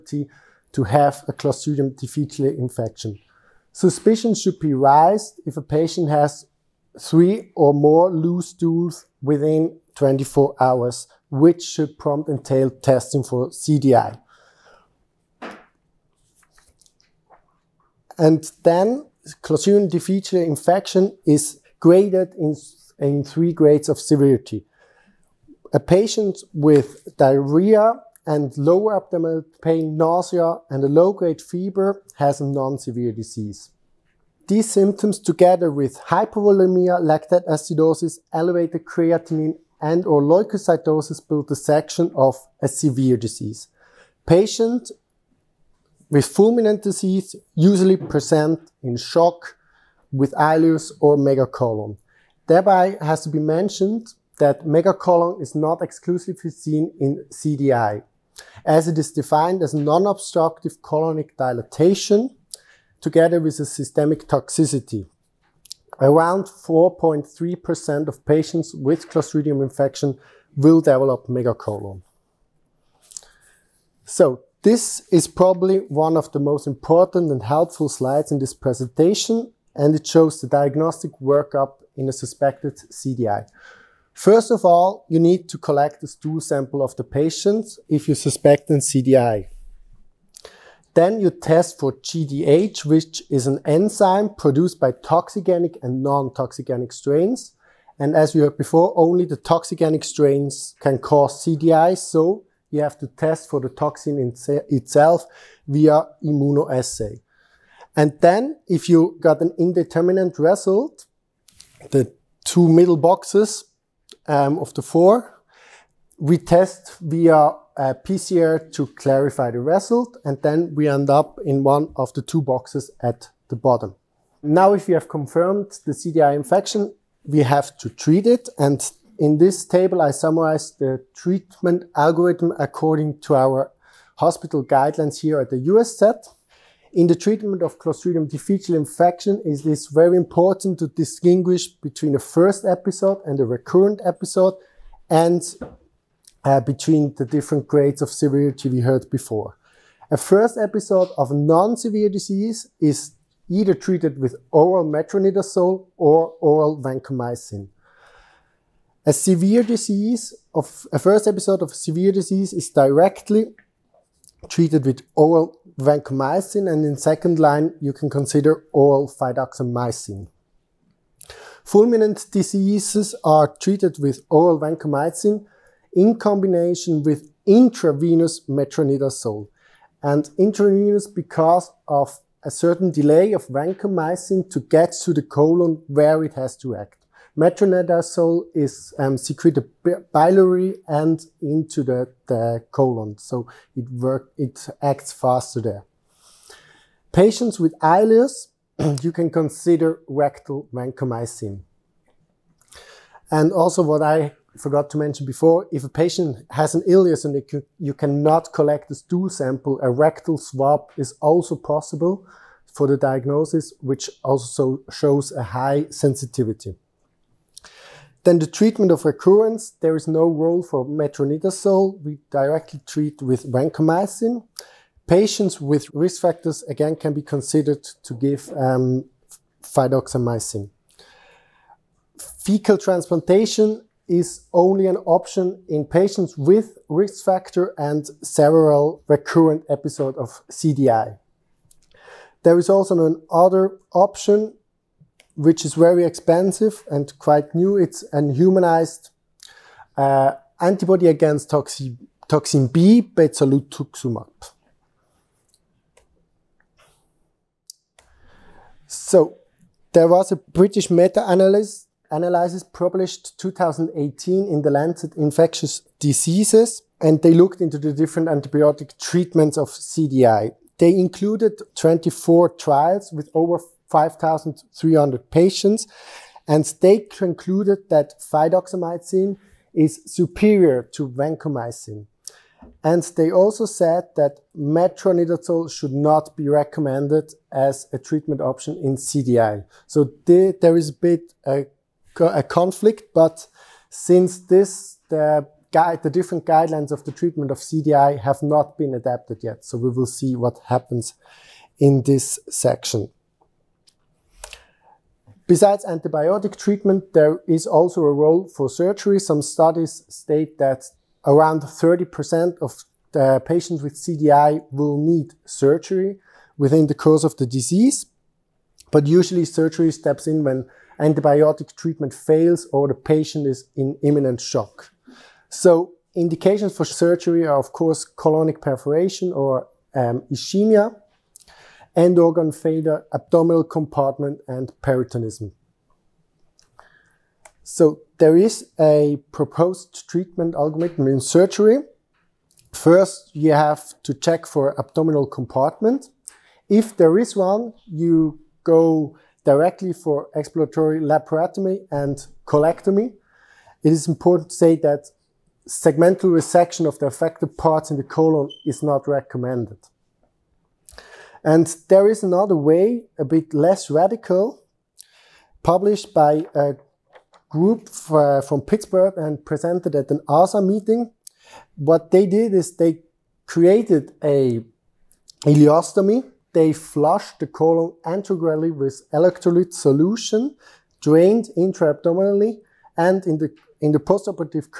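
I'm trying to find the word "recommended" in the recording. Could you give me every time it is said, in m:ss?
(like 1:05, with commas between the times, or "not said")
4:46, 5:59.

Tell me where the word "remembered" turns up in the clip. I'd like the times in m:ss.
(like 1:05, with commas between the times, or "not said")
not said.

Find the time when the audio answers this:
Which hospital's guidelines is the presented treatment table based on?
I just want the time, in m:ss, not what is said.
2:15.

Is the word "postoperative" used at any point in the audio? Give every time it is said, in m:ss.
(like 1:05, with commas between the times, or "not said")
6:23.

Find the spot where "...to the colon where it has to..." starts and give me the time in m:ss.
3:05.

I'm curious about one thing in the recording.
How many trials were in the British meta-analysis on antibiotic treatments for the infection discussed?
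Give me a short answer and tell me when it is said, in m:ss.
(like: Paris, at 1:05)
24, at 4:31.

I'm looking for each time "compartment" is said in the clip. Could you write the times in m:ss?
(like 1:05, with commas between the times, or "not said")
5:33, 5:45.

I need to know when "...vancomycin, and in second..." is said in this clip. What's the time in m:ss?
2:45.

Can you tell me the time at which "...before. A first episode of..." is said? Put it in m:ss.
2:29.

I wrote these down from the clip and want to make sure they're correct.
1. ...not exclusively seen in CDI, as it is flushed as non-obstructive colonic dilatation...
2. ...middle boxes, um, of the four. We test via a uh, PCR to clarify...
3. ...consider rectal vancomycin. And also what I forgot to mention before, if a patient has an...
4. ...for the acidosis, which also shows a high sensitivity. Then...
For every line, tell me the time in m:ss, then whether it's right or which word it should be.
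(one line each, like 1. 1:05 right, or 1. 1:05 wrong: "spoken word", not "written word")
1. 0:55 wrong: "defined", not "flushed"
2. 1:52 right
3. 3:19 right
4. 3:32 wrong: "diagnosis", not "acidosis".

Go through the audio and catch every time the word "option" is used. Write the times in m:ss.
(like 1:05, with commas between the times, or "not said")
3:55, 4:03, 4:48.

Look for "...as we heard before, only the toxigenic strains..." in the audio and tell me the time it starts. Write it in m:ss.
1:38.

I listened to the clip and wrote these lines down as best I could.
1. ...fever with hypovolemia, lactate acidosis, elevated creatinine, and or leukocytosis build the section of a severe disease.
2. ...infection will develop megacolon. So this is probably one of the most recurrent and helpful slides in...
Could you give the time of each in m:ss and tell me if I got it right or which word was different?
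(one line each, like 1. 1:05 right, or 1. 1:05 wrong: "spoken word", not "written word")
1. 0:35 wrong: "together", not "fever"
2. 1:09 wrong: "important", not "recurrent".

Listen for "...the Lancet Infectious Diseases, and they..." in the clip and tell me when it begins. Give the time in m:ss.
4:24.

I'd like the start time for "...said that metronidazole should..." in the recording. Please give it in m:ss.
4:43.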